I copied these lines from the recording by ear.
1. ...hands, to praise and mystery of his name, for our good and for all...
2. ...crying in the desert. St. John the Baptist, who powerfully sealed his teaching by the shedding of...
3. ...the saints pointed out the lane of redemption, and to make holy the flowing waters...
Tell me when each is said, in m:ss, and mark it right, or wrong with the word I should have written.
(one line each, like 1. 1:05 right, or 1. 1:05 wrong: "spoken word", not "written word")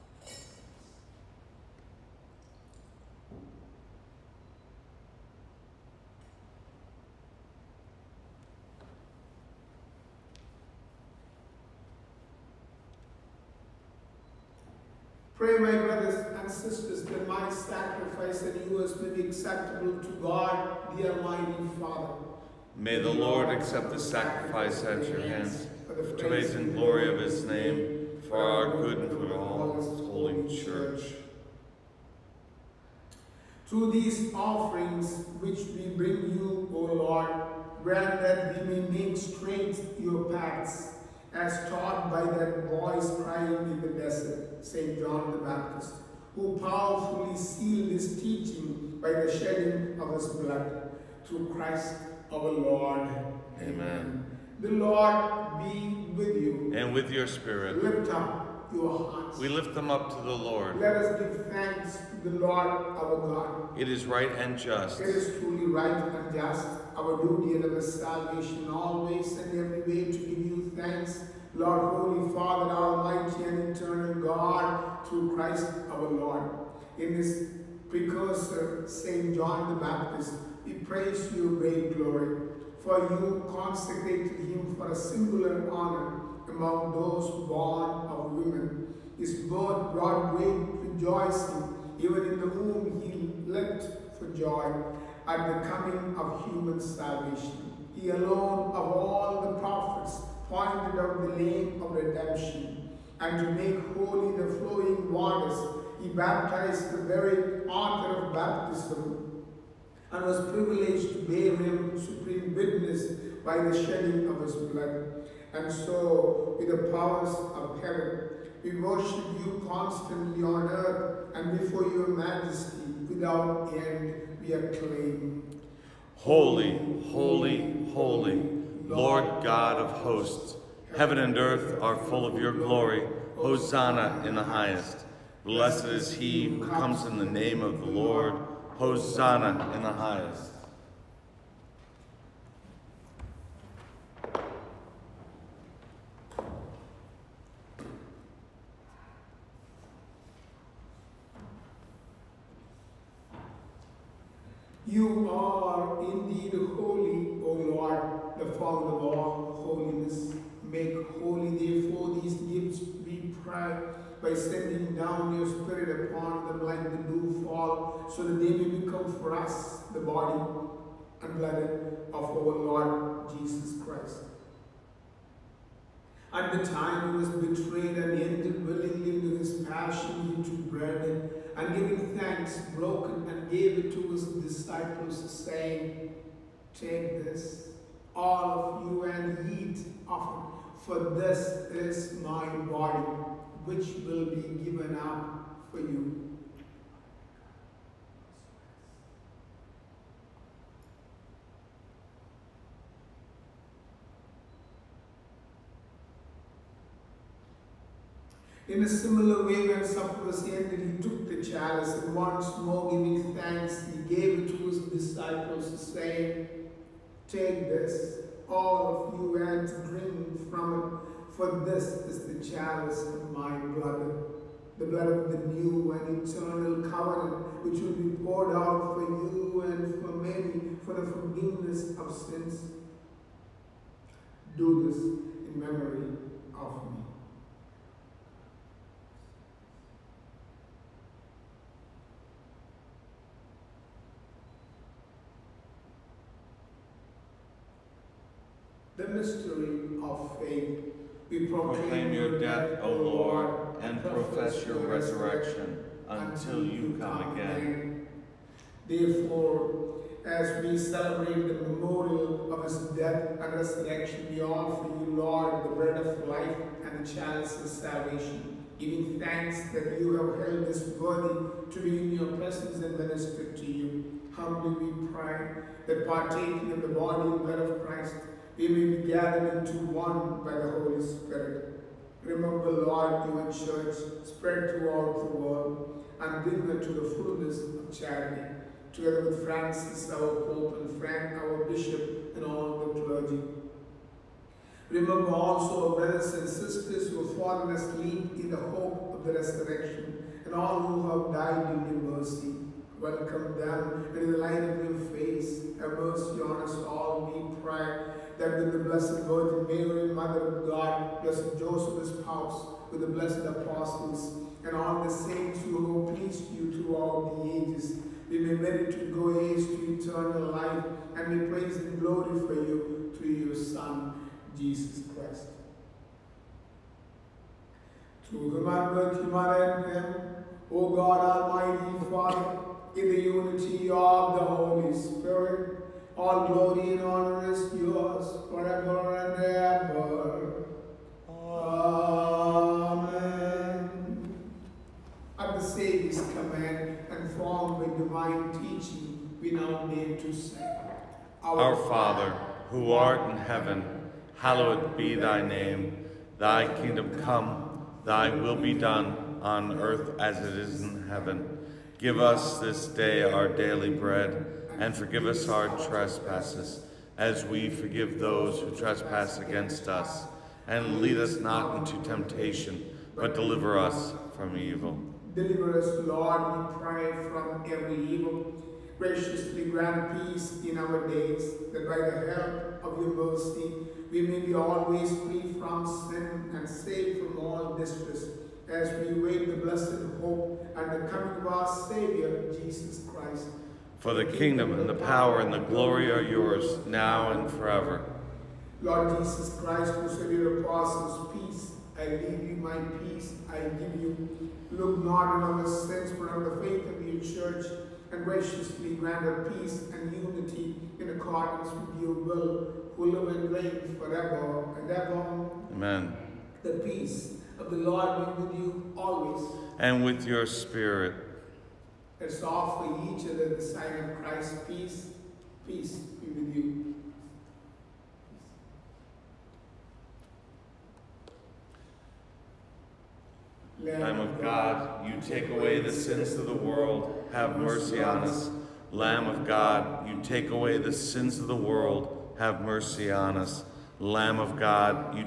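1. 0:25 wrong: "glory", not "mystery"
2. 0:43 right
3. 1:39 wrong: "prophets", not "saints".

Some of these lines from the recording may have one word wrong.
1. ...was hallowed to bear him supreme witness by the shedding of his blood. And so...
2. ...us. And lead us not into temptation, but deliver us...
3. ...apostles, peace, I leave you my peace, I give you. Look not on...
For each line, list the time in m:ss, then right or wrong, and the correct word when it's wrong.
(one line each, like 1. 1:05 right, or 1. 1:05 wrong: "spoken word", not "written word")
1. 1:50 wrong: "privileged", not "hallowed"
2. 6:09 right
3. 6:40 right.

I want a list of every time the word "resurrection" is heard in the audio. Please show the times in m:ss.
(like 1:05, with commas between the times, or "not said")
4:14, 4:23, 4:59.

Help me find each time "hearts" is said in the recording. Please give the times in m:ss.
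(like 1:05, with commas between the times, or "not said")
0:59.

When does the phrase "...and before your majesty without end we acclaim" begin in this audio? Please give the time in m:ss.
2:01.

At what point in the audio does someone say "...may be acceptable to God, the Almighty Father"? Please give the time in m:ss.
0:18.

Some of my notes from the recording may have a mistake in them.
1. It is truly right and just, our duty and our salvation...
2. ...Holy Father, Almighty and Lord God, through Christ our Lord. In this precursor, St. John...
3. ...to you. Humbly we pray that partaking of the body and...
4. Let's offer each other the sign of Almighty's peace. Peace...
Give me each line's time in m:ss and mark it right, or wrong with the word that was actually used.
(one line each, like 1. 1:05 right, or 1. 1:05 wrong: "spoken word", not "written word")
1. 1:05 right
2. 1:11 wrong: "Eternal", not "Lord"
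3. 4:33 right
4. 7:02 wrong: "Christ", not "Almighty".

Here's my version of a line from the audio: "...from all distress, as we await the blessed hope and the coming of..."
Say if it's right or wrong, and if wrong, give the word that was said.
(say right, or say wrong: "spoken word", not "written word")
right.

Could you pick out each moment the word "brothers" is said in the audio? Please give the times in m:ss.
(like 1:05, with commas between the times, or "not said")
0:15, 4:55.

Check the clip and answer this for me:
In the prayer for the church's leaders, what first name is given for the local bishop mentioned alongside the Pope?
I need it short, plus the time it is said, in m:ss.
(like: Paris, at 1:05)
Frank, at 4:51.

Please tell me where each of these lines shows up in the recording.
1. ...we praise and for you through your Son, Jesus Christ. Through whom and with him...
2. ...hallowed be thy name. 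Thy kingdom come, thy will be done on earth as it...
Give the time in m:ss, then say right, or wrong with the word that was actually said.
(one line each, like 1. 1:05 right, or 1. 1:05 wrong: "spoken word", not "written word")
1. 5:21 right
2. 5:54 right.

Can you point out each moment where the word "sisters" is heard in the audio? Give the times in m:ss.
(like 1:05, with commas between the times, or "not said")
0:16, 4:56.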